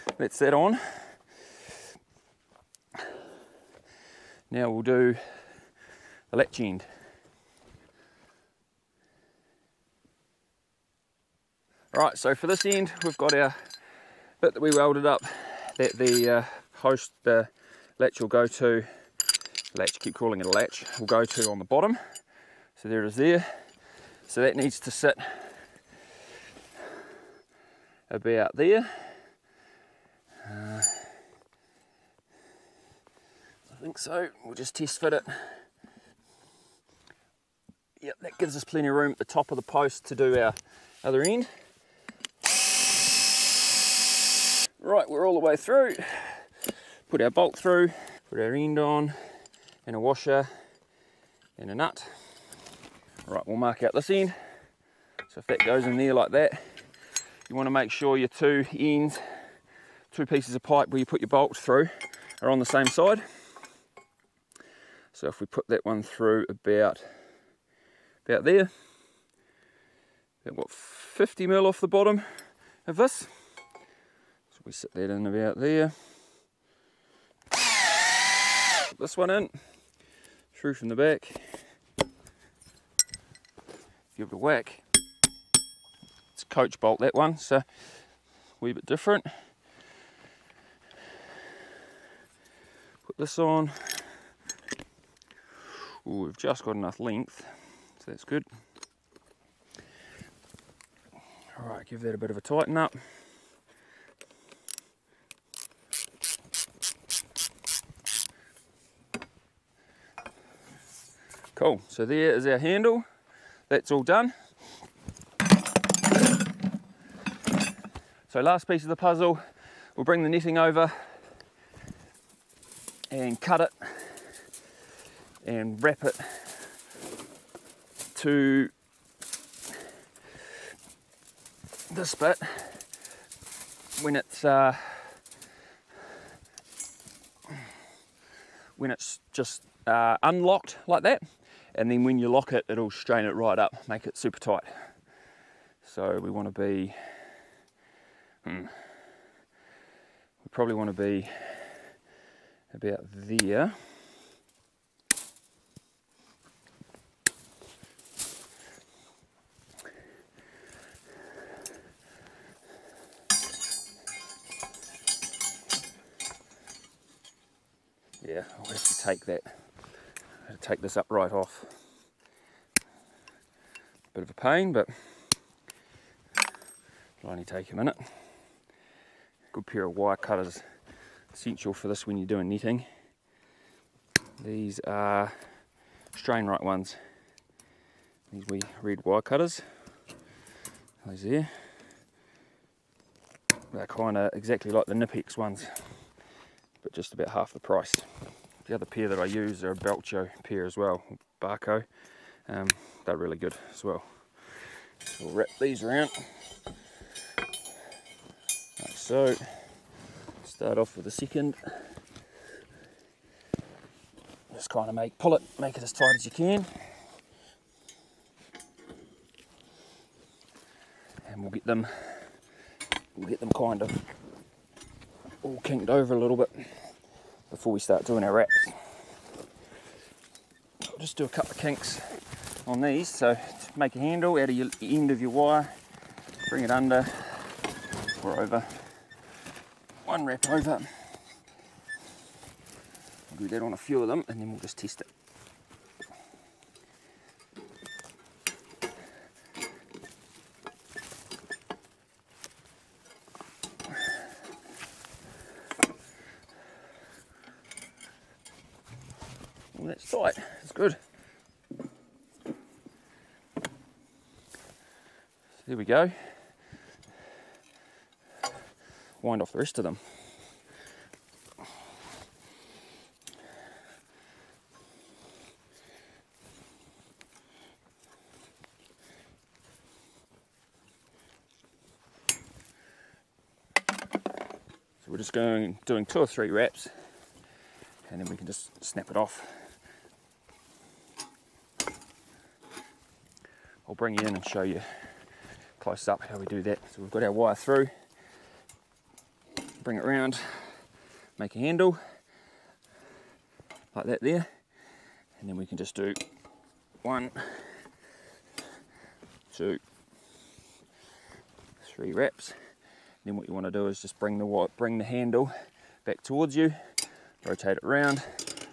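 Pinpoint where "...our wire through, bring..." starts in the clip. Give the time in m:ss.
4:57.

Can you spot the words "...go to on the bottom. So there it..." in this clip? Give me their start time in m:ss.
0:21.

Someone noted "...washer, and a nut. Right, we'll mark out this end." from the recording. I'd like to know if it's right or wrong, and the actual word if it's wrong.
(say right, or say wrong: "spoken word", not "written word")
right.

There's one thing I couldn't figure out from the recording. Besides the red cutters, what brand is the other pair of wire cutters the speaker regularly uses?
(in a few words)
Bahco.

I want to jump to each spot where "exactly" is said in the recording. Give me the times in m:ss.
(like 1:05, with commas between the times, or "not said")
3:14.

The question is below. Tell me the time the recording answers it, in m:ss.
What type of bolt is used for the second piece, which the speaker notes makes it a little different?
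1:26.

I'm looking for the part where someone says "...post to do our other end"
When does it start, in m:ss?
0:39.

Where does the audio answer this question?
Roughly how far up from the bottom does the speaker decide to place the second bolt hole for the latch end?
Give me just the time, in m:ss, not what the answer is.
1:10.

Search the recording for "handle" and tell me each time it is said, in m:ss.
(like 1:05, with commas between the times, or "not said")
1:52, 3:53, 5:01, 5:15.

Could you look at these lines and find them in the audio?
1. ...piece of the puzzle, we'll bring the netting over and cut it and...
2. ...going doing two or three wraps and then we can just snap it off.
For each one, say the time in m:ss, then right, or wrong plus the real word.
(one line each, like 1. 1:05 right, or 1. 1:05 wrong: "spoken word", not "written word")
1. 1:58 right
2. 4:45 right.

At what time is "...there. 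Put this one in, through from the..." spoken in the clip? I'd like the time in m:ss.
1:15.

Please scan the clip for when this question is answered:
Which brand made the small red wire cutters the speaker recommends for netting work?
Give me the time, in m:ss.
3:06.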